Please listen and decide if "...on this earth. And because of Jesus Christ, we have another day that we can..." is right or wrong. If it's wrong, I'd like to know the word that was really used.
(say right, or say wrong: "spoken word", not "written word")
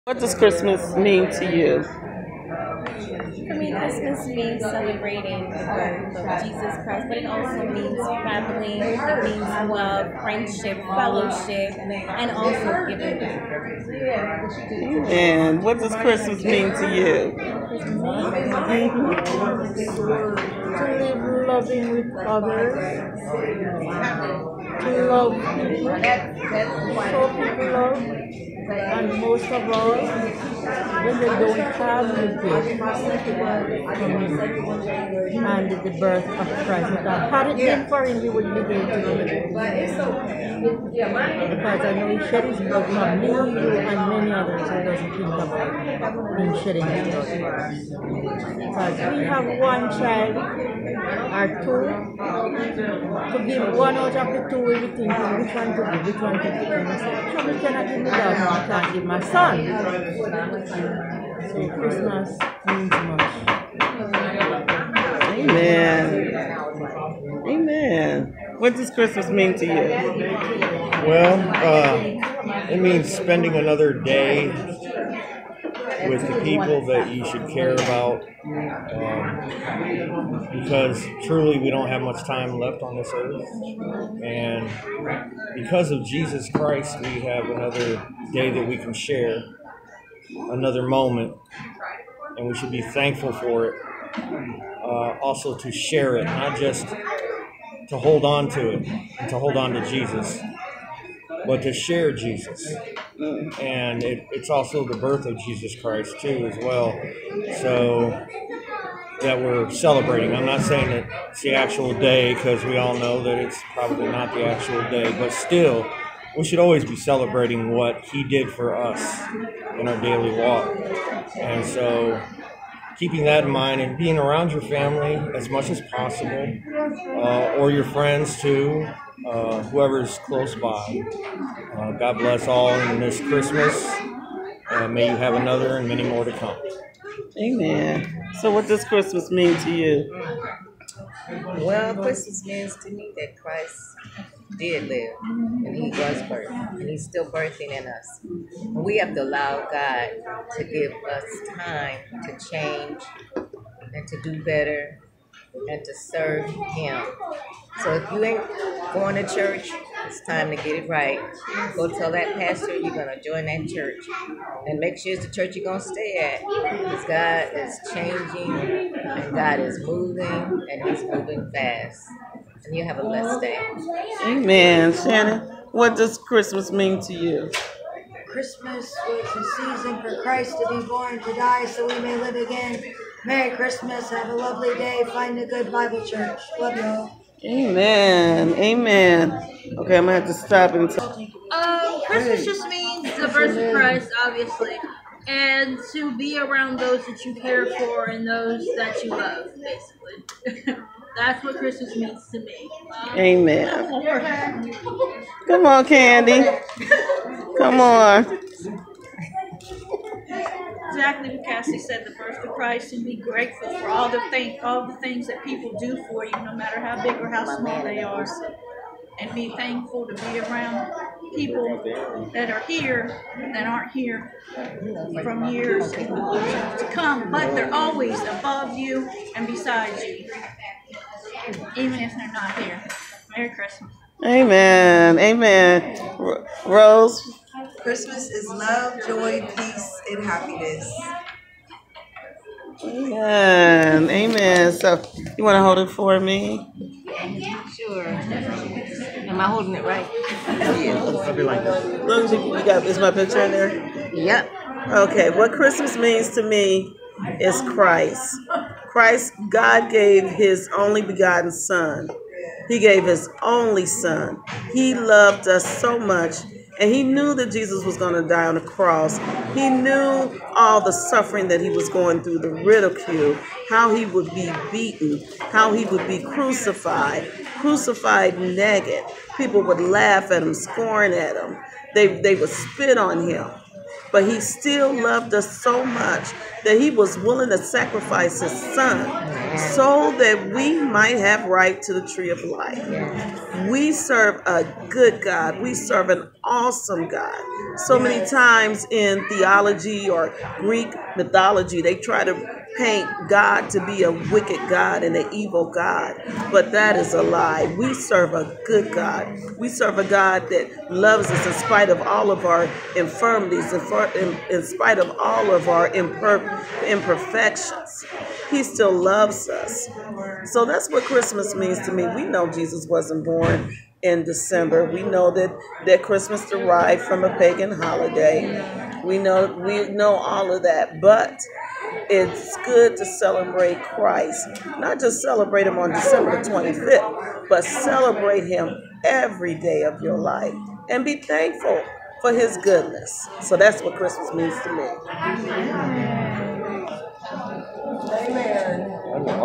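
right.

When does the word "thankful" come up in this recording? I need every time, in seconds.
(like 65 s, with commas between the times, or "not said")
92 s, 219 s, 341 s.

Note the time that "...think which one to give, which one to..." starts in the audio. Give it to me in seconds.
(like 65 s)
54 s.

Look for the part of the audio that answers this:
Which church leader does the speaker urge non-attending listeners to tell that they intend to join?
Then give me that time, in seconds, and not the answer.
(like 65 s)
162 s.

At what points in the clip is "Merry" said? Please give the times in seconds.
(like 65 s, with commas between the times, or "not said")
183 s, 233 s.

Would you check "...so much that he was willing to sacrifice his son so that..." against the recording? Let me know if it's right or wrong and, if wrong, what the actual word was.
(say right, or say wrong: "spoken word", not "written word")
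right.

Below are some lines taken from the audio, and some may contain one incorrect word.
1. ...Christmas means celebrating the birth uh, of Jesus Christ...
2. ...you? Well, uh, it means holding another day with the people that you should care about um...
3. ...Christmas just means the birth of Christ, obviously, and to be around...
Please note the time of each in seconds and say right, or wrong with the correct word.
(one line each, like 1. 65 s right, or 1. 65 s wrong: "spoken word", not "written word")
1. 3 s right
2. 69 s wrong: "spending", not "holding"
3. 192 s right.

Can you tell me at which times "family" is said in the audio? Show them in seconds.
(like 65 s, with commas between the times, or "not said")
7 s, 124 s.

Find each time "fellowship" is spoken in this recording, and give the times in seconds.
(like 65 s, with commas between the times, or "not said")
10 s.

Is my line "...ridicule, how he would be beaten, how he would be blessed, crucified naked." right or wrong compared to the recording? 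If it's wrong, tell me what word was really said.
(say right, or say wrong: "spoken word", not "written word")
wrong: "crucified", not "blessed".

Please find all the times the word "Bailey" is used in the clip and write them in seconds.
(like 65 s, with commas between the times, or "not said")
not said.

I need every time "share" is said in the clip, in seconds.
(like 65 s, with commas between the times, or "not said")
88 s, 95 s, 101 s.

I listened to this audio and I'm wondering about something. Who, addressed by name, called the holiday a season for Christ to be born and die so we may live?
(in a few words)
Shannon.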